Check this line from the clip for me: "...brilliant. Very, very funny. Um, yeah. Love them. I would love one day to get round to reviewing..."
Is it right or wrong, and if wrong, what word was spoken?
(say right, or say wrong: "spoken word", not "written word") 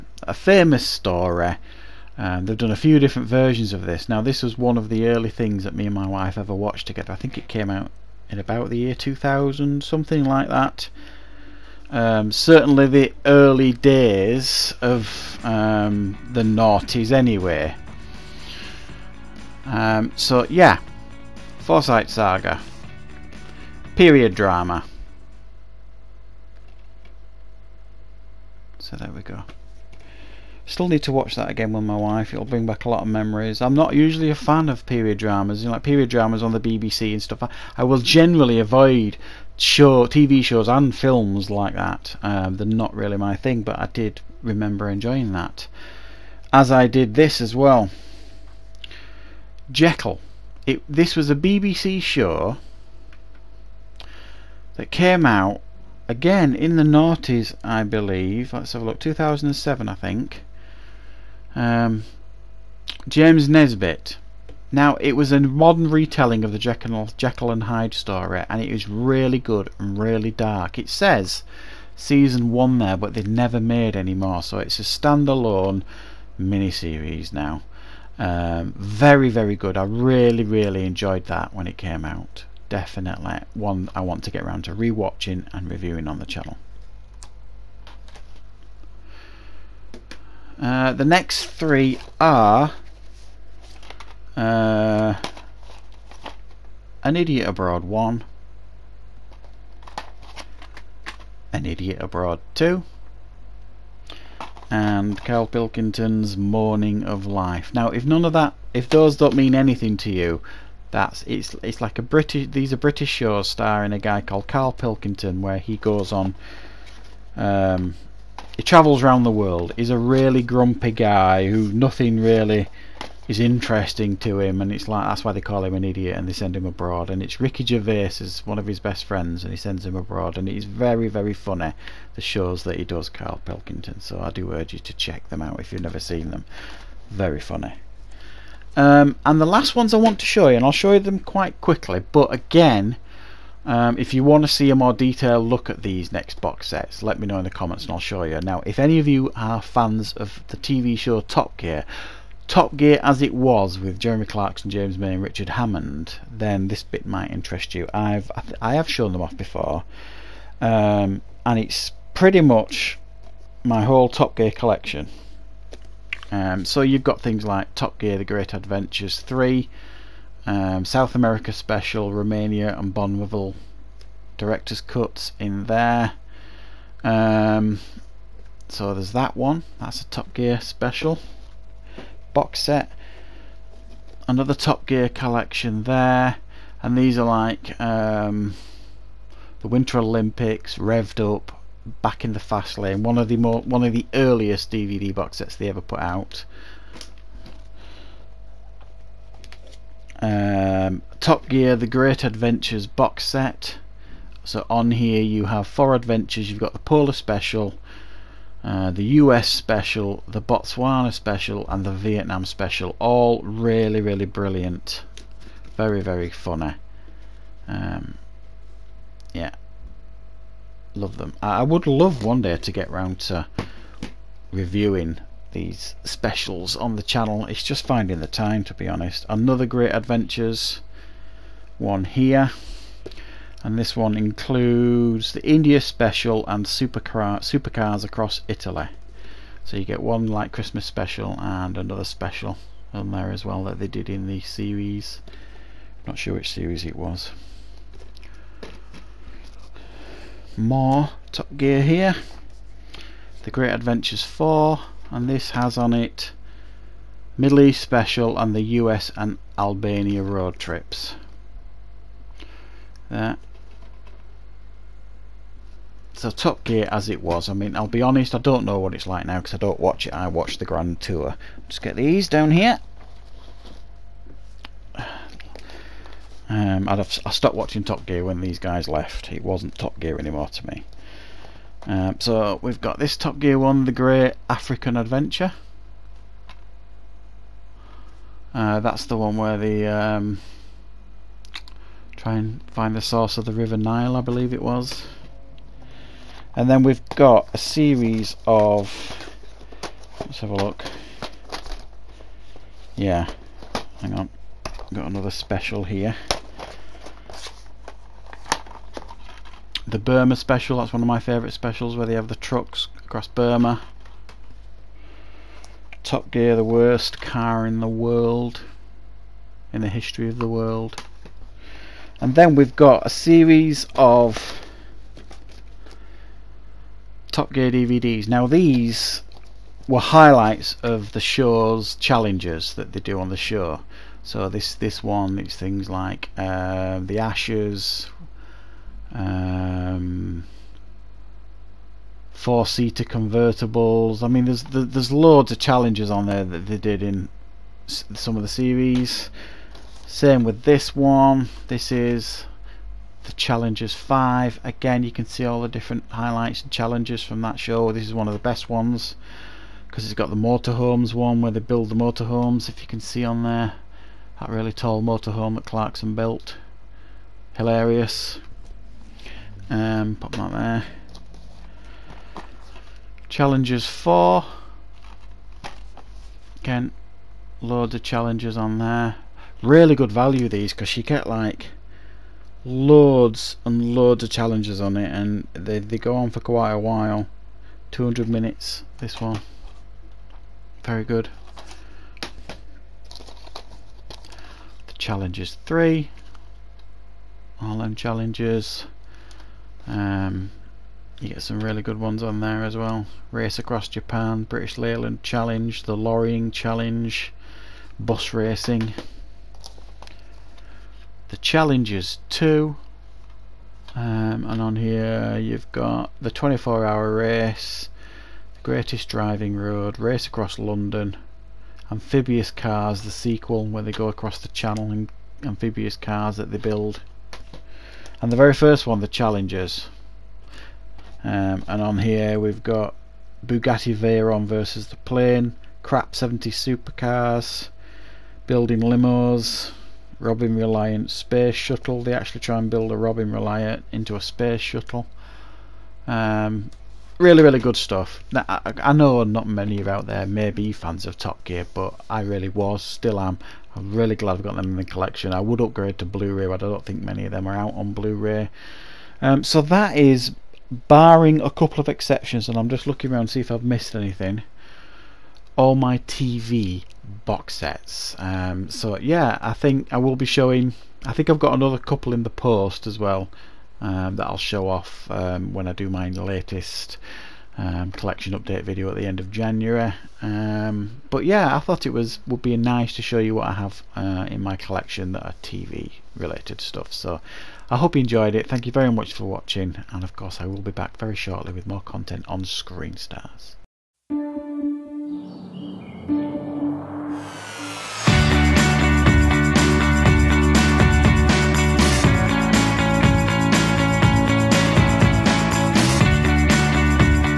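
right.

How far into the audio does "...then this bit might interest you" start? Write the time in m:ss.
2:36.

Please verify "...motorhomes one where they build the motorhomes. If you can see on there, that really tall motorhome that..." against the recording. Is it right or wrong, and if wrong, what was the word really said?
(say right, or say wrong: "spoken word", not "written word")
right.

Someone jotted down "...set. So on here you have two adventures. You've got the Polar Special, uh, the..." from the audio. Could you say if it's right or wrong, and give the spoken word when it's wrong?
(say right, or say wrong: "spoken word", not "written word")
wrong: "four", not "two".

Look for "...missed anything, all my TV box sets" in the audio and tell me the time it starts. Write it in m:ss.
7:43.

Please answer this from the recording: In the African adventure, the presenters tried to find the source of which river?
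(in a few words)
River Nile.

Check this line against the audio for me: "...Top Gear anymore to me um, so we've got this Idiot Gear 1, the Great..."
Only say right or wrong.
wrong.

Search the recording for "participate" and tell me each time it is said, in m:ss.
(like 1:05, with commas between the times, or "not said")
not said.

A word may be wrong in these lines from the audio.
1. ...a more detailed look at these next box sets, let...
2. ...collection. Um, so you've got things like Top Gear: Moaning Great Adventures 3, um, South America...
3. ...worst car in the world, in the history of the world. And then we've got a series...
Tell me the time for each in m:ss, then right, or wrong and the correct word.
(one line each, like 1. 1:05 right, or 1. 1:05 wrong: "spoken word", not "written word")
1. 2:24 right
2. 2:44 wrong: "The", not "Moaning"
3. 5:16 right.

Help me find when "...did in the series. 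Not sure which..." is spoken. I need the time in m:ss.
4:03.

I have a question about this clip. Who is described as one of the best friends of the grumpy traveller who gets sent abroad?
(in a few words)
Ricky Gervais.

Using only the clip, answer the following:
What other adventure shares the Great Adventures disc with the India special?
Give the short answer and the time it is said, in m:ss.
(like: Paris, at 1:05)
supercars across Italy, at 3:57.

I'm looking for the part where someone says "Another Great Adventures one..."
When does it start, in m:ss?
3:49.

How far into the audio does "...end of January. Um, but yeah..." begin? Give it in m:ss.
7:59.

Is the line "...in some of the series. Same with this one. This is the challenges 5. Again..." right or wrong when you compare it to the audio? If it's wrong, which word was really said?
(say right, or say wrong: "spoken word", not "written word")
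right.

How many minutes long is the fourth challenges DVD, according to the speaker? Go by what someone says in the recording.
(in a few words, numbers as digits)
200.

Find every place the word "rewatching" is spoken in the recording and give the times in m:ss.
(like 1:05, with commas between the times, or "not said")
1:24.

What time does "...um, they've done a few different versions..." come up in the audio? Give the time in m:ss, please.
0:02.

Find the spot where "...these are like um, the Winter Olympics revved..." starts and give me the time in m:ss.
3:06.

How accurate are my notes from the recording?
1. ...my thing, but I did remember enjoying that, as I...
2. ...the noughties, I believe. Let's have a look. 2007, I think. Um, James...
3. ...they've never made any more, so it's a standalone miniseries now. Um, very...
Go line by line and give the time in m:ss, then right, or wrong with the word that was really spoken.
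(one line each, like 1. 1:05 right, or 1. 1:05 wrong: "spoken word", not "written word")
1. 0:43 right
2. 0:56 right
3. 1:13 right.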